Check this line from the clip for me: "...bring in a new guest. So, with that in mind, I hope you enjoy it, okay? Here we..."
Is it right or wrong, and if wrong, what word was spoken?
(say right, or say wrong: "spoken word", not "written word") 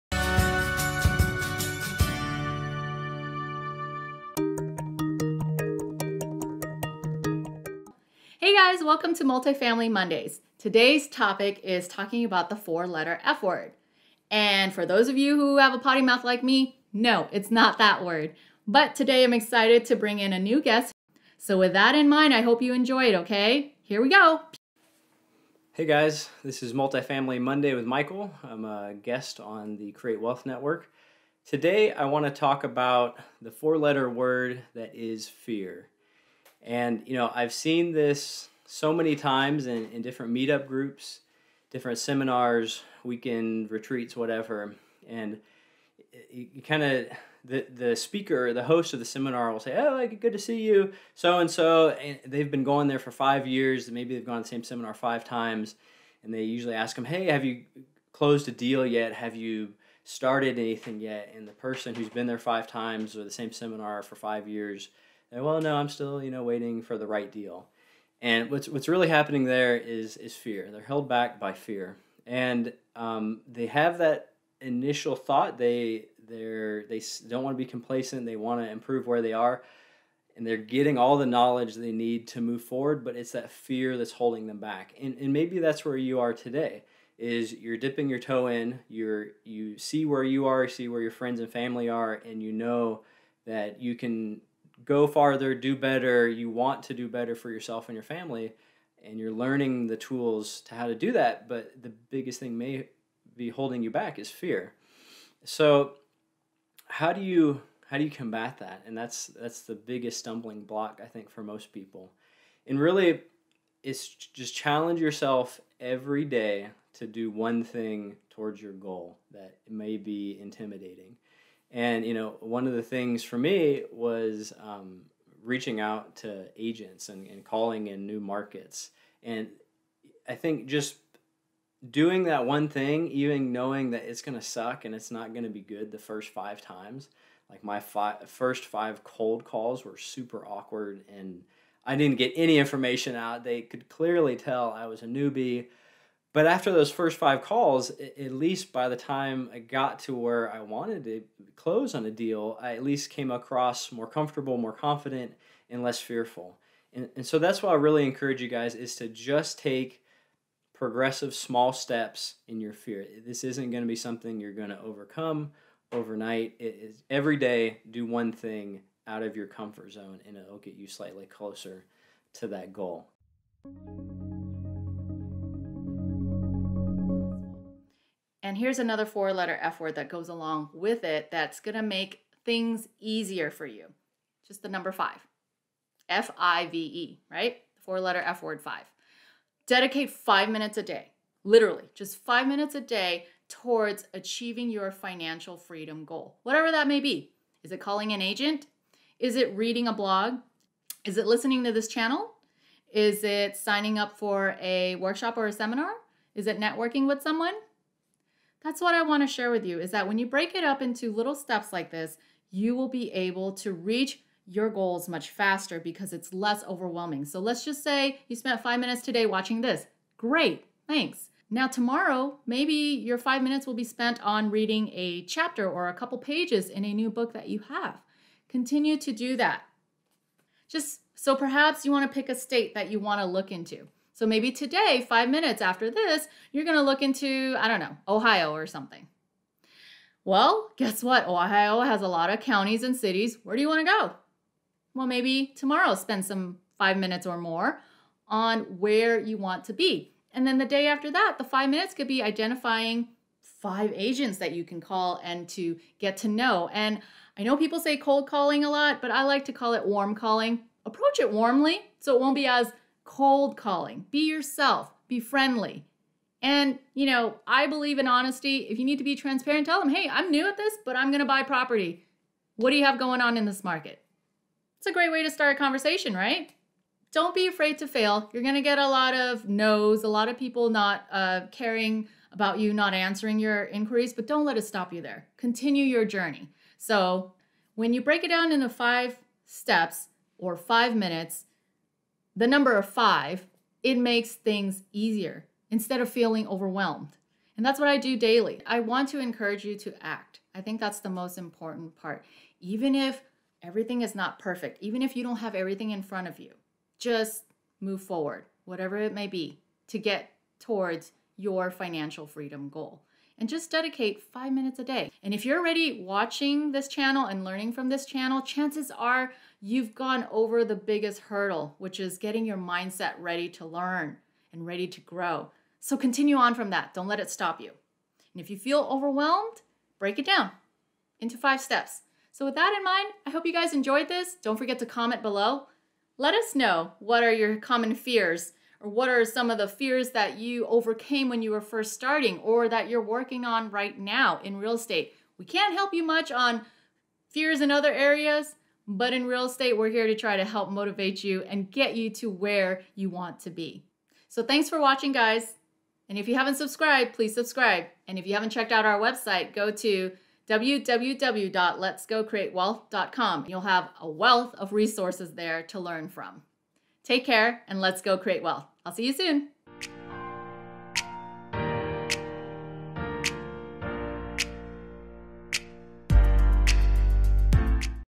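right.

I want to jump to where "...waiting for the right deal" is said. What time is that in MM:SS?
01:06.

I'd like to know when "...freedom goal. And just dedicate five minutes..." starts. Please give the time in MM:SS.
05:12.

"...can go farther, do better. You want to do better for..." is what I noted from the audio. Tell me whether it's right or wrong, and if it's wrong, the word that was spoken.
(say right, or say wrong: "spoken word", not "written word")
right.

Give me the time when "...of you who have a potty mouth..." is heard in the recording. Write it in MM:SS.
00:15.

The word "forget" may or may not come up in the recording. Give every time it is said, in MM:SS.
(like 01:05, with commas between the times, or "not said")
05:34.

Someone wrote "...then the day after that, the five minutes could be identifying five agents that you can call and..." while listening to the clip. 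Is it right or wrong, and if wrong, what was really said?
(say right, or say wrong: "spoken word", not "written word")
right.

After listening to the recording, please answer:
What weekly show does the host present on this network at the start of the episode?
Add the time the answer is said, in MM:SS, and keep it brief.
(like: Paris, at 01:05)
Multifamily Mondays, at 00:09.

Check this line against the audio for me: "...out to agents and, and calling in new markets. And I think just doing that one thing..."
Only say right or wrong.
right.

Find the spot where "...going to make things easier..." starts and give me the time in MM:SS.
03:01.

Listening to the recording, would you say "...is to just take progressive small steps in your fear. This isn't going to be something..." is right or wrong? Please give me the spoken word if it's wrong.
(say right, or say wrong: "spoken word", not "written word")
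right.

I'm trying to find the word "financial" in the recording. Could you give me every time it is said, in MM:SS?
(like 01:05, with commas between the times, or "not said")
03:14, 05:11.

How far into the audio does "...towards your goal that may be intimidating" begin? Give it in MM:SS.
01:58.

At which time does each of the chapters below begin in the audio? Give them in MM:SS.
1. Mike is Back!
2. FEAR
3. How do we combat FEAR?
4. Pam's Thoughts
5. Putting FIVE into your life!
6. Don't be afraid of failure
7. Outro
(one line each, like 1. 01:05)
1. 00:24
2. 01:09
3. 01:46
4. 02:53
5. 03:51
6. 04:40
7. 06:09.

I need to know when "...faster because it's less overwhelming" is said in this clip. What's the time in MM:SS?
03:35.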